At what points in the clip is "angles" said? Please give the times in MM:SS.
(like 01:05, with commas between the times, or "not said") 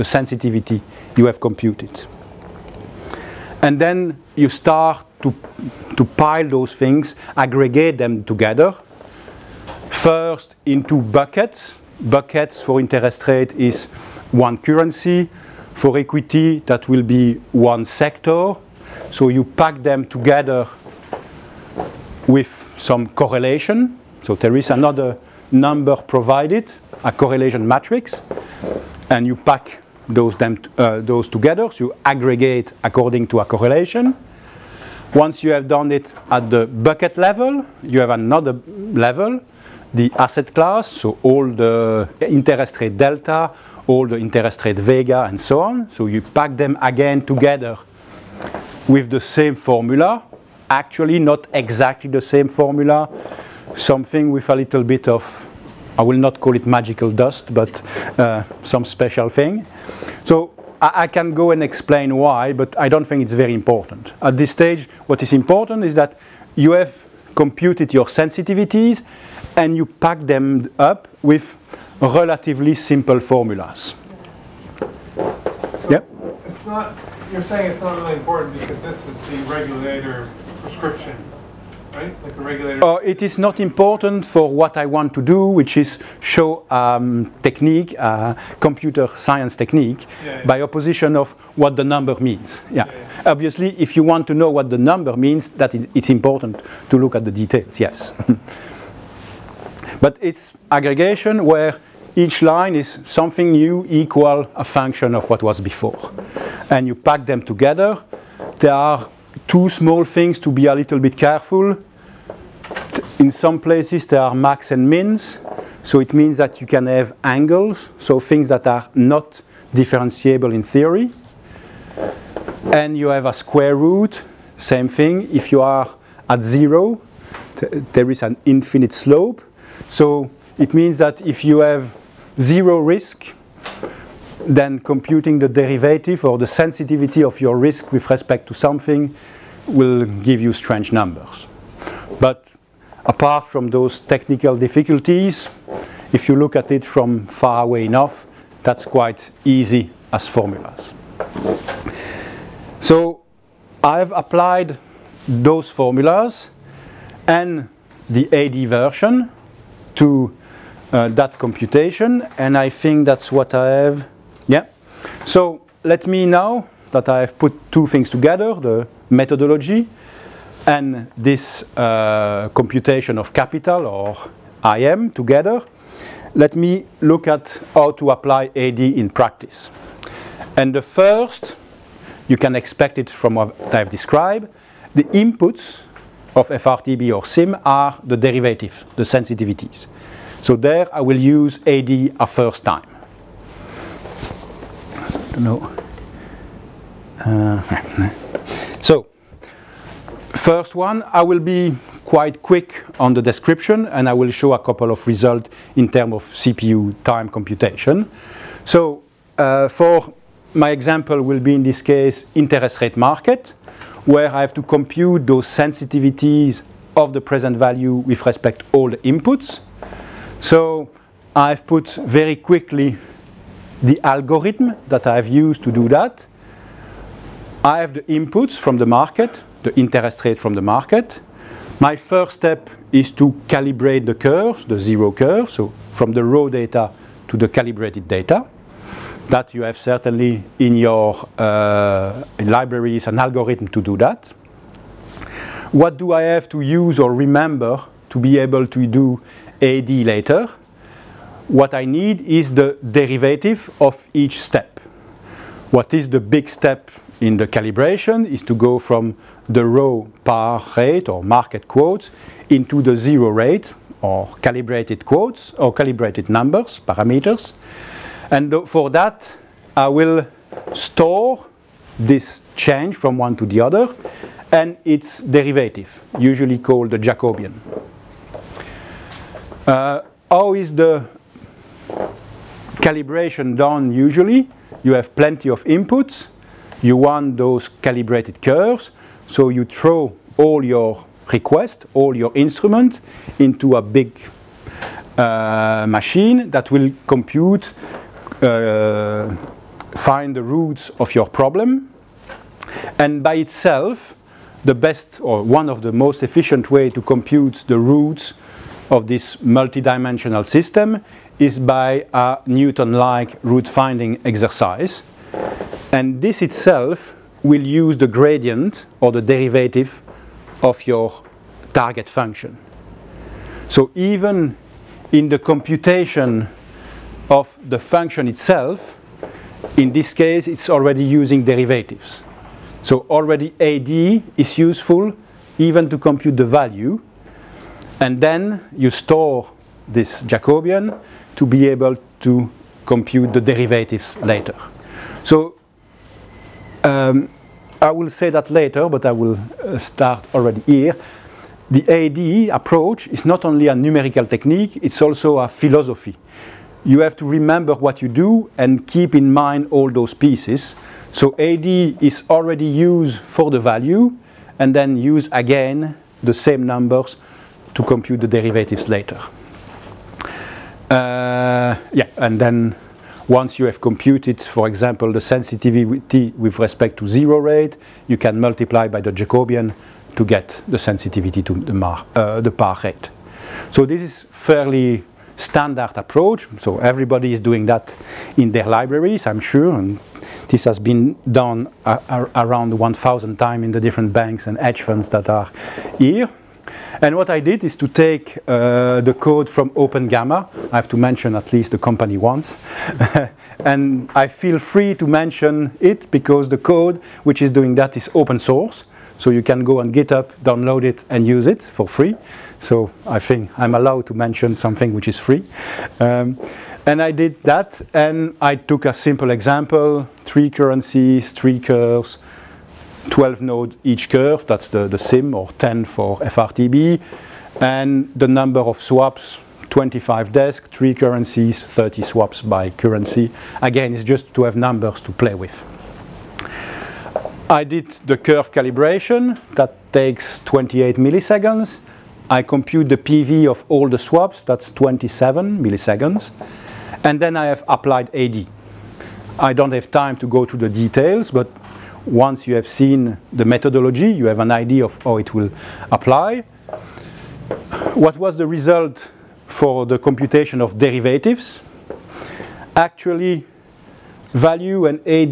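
01:57.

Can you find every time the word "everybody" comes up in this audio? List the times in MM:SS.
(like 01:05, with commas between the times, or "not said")
06:26.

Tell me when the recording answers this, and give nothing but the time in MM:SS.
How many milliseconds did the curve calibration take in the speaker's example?
07:19.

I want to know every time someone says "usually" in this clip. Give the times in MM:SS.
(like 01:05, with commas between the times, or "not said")
04:36, 04:43.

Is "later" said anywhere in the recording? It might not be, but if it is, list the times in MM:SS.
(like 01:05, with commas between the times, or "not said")
04:09, 05:44, 05:48, 06:08.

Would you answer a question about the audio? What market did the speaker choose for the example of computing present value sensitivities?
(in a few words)
interest rate market.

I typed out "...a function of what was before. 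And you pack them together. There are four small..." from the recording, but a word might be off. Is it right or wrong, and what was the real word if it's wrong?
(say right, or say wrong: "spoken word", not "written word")
wrong: "two", not "four".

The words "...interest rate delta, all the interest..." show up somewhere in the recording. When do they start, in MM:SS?
00:42.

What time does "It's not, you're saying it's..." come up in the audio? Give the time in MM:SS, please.
01:16.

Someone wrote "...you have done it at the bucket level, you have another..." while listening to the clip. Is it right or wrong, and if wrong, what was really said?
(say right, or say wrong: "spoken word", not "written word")
right.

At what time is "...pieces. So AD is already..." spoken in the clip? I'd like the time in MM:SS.
06:00.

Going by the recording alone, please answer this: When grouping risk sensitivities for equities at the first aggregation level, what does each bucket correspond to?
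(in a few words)
one sector.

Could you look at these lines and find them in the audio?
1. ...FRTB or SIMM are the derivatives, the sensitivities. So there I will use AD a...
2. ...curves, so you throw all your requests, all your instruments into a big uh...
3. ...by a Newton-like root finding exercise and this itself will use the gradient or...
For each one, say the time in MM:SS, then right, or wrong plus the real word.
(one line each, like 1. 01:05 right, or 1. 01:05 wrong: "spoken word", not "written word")
1. 03:06 right
2. 04:48 right
3. 05:11 right.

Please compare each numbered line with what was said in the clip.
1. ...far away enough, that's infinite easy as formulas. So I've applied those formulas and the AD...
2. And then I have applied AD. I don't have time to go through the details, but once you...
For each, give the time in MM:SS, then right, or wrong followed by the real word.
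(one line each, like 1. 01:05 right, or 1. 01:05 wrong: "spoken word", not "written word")
1. 02:27 wrong: "quite", not "infinite"
2. 07:27 right.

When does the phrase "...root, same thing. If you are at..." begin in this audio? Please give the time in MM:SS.
02:03.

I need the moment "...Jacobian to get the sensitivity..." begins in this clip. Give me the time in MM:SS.
06:19.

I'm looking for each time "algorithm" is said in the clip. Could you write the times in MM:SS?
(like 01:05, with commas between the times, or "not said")
03:44, 04:03.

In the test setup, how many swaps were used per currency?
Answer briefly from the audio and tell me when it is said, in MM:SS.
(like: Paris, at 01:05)
30, at 07:11.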